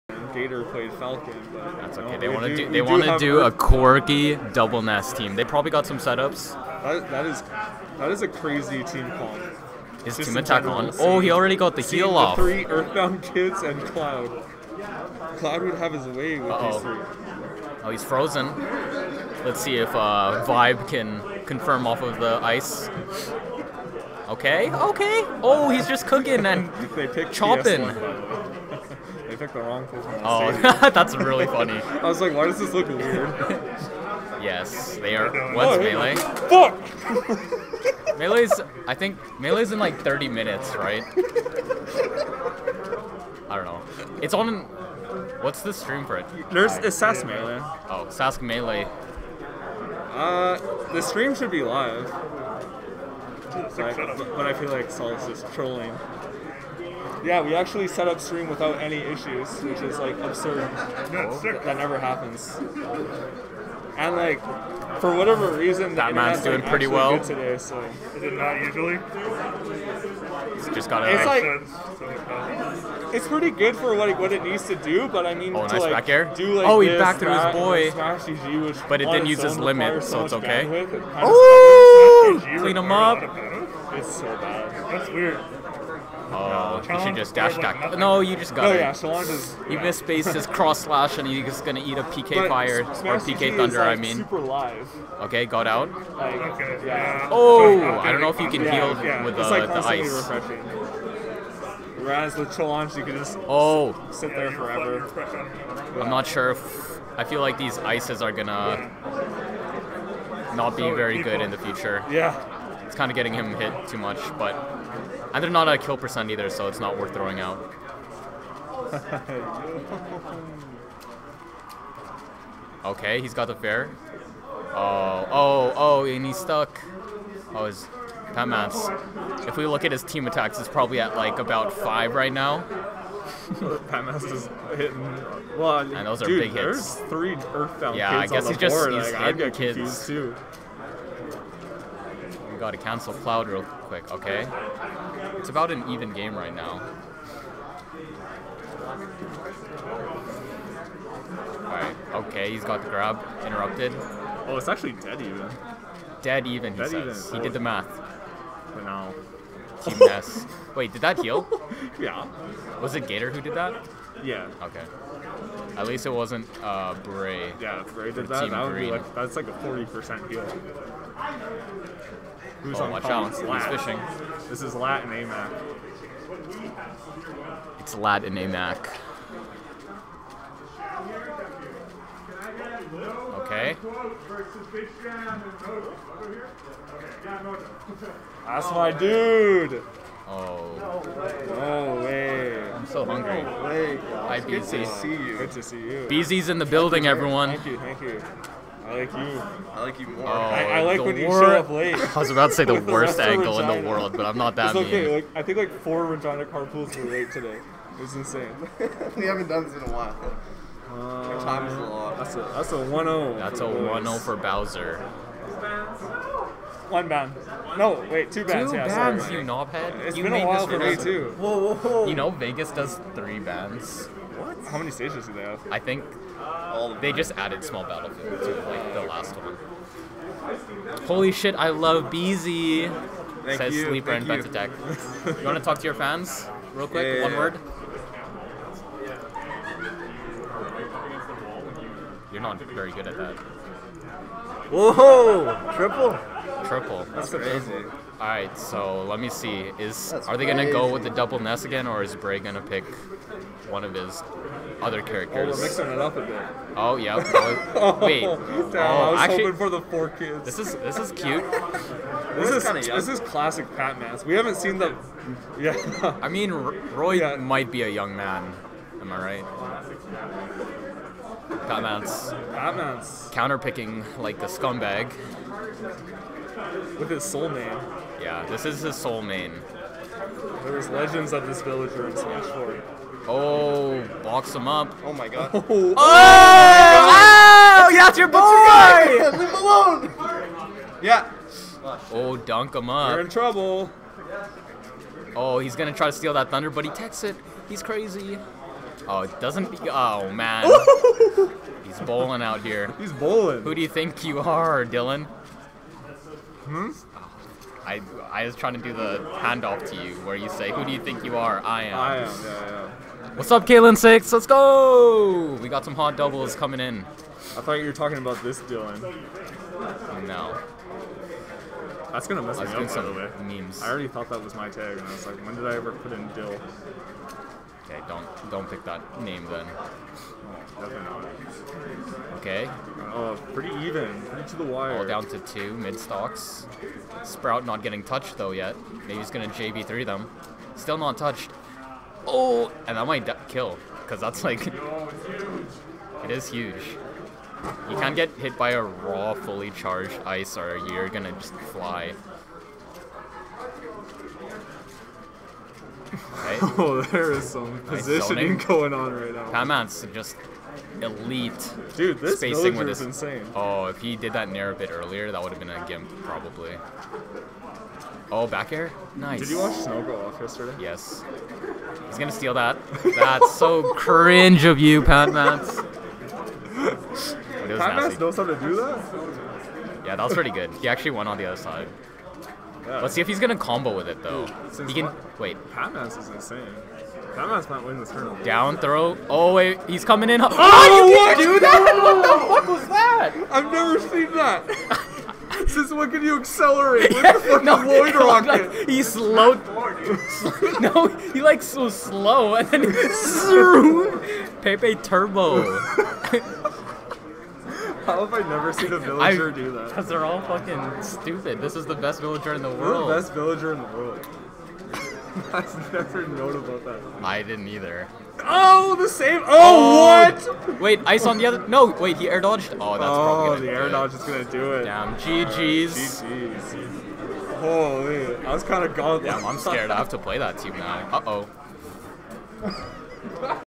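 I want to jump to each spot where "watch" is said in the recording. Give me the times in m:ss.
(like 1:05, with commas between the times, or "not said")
2:52, 6:09.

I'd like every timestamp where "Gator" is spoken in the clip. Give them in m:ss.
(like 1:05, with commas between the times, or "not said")
0:00, 2:43.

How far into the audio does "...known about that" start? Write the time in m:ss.
6:56.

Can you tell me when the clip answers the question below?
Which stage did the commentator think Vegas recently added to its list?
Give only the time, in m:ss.
3:47.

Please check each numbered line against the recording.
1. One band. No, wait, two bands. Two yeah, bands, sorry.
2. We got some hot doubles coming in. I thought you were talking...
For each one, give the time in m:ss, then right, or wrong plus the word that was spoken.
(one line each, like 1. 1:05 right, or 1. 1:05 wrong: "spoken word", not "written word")
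1. 3:36 right
2. 5:15 right.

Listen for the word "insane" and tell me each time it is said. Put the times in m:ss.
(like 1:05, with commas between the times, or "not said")
3:28, 6:03, 6:26.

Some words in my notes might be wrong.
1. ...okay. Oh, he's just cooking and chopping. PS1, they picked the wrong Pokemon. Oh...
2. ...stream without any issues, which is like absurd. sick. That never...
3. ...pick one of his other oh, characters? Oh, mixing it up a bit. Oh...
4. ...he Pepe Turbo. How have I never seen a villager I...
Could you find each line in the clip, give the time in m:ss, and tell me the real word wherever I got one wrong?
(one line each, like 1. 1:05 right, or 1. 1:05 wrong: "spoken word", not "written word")
1. 0:24 right
2. 0:58 right
3. 4:12 right
4. 6:42 right.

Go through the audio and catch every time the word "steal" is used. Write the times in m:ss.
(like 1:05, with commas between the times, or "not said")
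4:56, 6:12.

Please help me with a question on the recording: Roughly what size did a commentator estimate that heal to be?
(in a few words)
40 percent.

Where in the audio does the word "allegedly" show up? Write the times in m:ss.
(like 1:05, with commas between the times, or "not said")
not said.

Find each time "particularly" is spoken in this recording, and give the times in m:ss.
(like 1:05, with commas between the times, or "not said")
not said.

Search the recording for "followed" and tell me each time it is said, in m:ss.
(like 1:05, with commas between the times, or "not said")
not said.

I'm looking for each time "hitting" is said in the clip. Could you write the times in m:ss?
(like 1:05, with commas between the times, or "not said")
2:14, 2:19.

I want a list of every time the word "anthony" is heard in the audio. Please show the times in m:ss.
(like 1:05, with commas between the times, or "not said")
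not said.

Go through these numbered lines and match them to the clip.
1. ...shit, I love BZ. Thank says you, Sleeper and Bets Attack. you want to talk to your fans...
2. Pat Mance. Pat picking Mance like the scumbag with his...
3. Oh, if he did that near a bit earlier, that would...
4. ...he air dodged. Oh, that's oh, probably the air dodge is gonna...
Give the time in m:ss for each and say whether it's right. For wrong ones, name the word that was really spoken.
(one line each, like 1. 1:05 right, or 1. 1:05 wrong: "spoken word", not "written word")
1. 3:51 right
2. 4:31 wrong: "Counterpicking", not "Mance"
3. 6:03 right
4. 7:02 right.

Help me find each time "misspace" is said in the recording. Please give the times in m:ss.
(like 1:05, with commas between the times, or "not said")
1:29.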